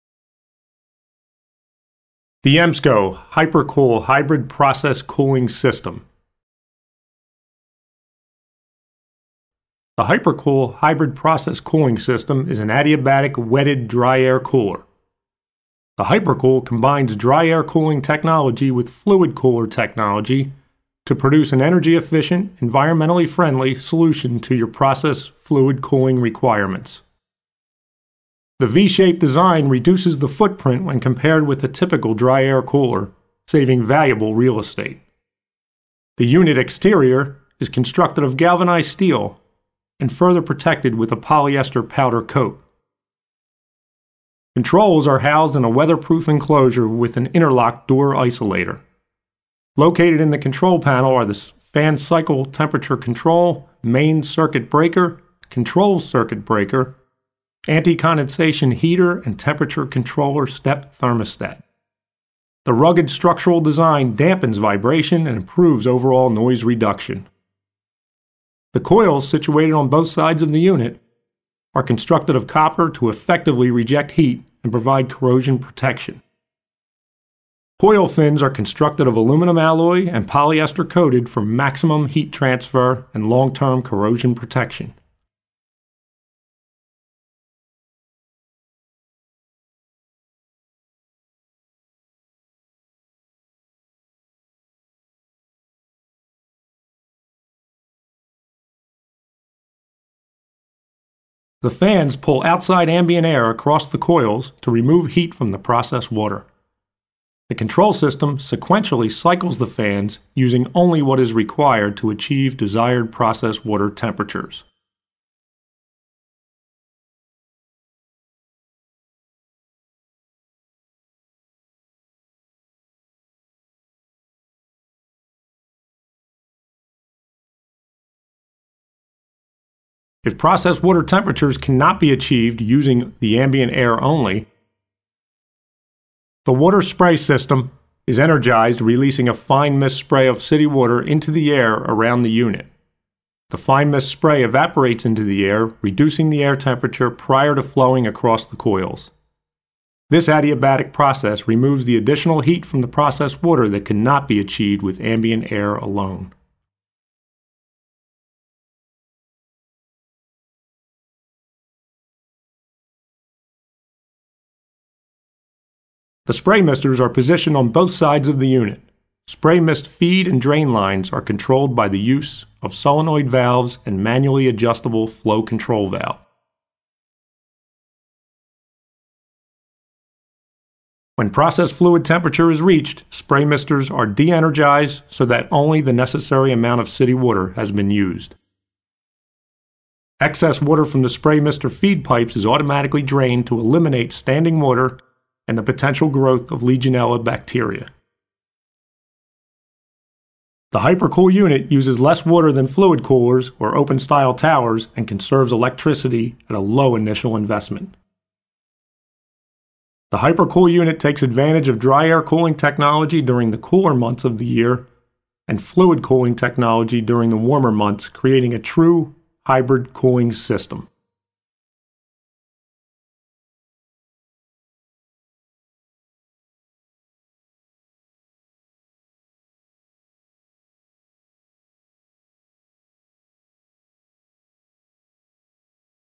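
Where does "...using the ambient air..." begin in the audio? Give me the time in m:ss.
2:12.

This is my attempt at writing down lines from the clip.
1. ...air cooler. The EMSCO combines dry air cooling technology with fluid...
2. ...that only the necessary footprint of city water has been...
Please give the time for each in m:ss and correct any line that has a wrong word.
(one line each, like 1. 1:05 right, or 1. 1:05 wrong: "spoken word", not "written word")
1. 0:14 wrong: "HyprCool", not "EMSCO"
2. 3:05 wrong: "amount", not "footprint".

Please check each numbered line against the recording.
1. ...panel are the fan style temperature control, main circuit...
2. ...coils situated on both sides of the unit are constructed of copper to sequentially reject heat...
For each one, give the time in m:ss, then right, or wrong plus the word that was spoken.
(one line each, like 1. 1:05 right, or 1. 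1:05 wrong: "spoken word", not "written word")
1. 0:50 wrong: "cycle", not "style"
2. 1:08 wrong: "effectively", not "sequentially".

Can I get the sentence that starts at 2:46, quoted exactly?
The spray misters are positioned on both sides of the unit.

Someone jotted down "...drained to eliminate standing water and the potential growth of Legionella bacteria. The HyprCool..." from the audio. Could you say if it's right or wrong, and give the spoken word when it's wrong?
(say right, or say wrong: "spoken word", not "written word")
right.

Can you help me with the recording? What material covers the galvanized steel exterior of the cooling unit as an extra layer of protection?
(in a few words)
polyester powder coat.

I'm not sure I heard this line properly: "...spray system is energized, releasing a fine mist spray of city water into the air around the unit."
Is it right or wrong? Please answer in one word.
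right.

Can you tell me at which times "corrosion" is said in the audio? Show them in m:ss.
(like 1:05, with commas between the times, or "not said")
1:15, 1:23.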